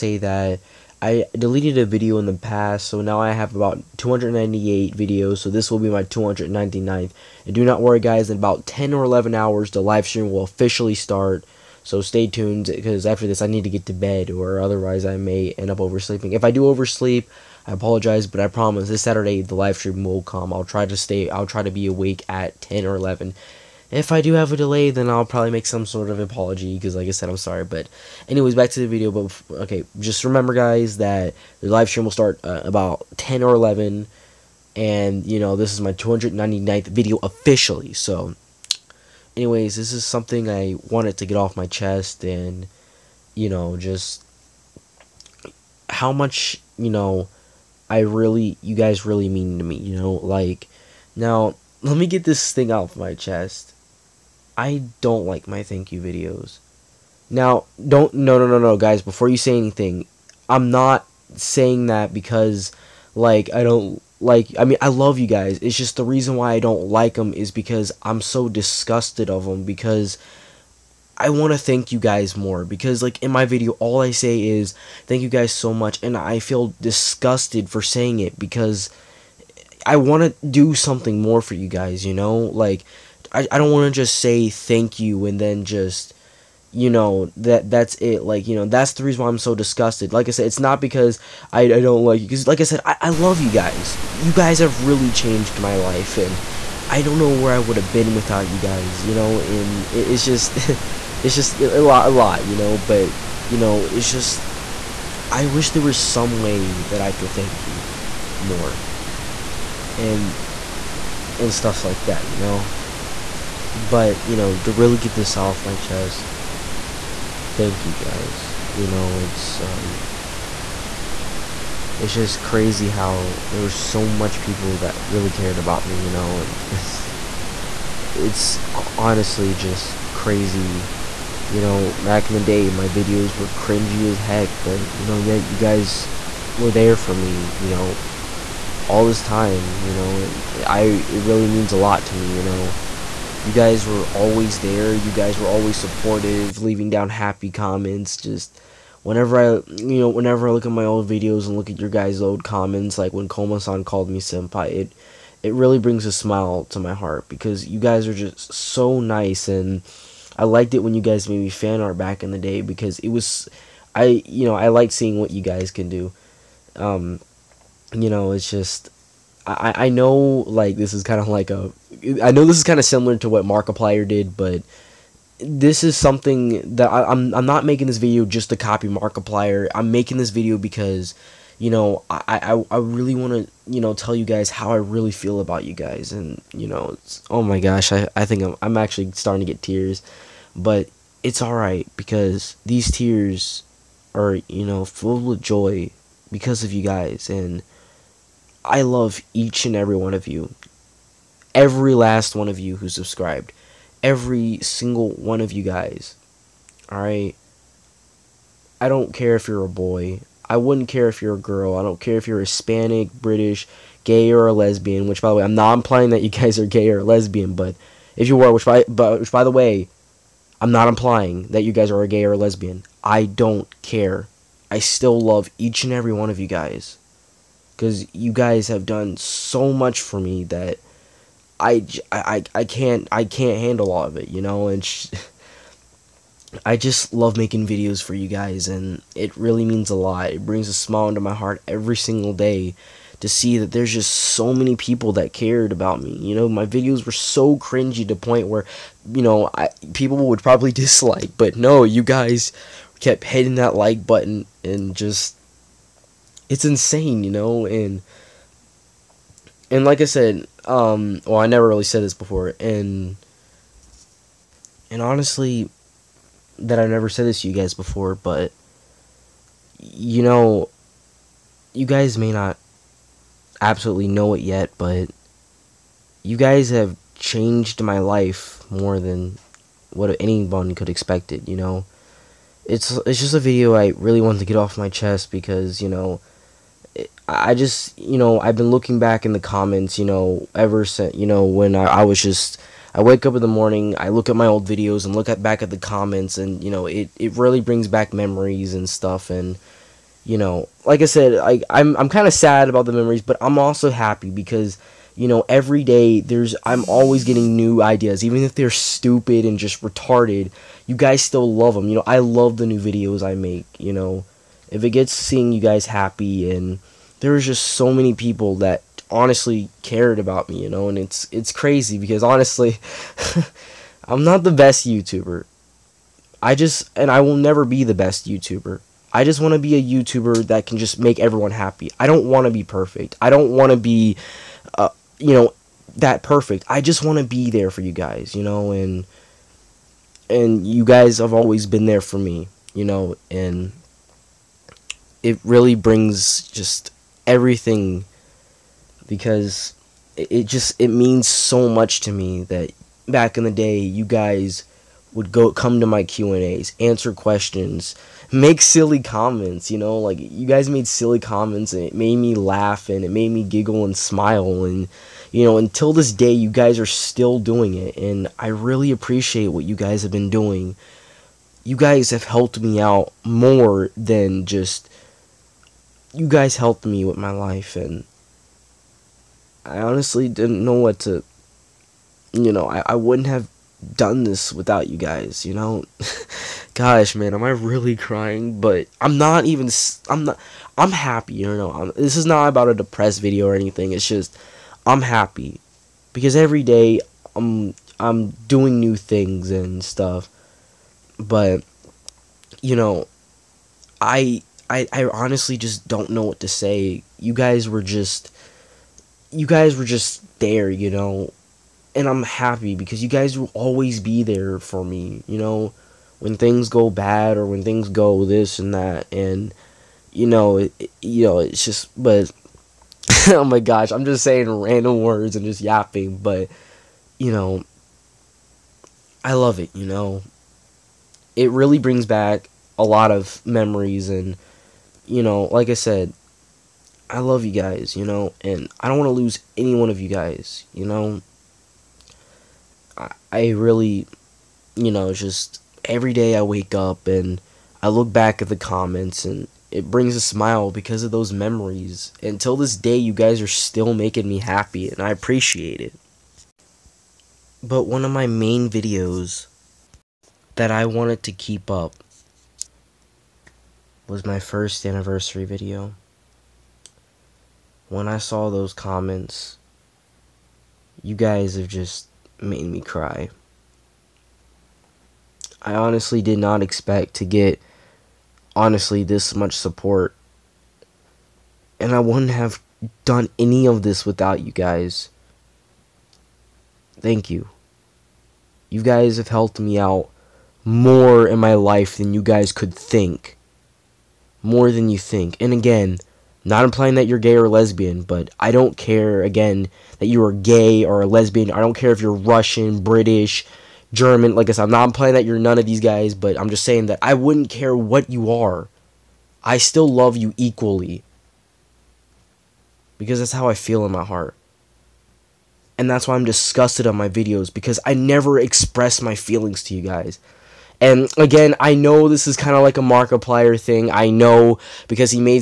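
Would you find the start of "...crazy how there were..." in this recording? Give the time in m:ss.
2:02.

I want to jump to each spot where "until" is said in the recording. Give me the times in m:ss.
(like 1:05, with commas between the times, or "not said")
6:05, 7:32.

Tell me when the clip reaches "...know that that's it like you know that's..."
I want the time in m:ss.
1:26.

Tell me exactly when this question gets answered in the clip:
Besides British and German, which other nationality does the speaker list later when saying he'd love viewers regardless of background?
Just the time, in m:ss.
8:22.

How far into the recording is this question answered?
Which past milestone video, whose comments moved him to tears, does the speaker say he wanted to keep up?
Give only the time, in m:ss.
7:44.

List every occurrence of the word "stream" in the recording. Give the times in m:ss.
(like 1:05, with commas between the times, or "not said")
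0:10, 0:19, 0:31.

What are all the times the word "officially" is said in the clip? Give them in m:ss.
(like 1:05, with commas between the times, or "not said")
0:10, 0:37.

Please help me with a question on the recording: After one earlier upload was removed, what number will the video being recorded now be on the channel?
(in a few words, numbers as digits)
299th.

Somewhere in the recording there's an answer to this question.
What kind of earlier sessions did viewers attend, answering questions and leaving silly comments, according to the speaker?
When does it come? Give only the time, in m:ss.
5:56.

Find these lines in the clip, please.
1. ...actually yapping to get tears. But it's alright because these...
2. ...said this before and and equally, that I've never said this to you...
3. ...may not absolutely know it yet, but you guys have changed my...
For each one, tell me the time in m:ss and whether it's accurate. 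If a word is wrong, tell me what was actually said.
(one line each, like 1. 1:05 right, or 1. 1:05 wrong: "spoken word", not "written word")
1. 3:08 wrong: "starting", not "yapping"
2. 4:21 wrong: "honestly", not "equally"
3. 4:32 right.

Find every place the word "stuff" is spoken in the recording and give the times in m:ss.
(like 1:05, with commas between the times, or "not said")
1:51, 4:58, 6:39.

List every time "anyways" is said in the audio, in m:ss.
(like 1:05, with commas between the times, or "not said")
0:28, 0:39.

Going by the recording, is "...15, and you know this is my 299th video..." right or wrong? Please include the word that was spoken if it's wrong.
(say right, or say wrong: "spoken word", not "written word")
wrong: "11", not "15".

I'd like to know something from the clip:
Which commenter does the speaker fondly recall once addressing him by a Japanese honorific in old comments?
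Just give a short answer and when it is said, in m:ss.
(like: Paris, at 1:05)
Koma-san, at 2:33.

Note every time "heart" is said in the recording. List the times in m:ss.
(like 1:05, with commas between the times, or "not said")
2:36, 4:01, 8:34.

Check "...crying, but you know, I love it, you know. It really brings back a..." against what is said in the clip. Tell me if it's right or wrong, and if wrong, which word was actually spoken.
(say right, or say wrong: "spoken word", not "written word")
wrong: "yapping", not "crying".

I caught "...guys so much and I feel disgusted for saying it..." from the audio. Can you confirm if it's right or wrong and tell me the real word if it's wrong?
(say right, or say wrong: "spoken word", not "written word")
right.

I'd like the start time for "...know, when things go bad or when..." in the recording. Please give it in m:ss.
6:55.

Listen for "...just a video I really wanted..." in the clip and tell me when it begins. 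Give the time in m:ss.
4:43.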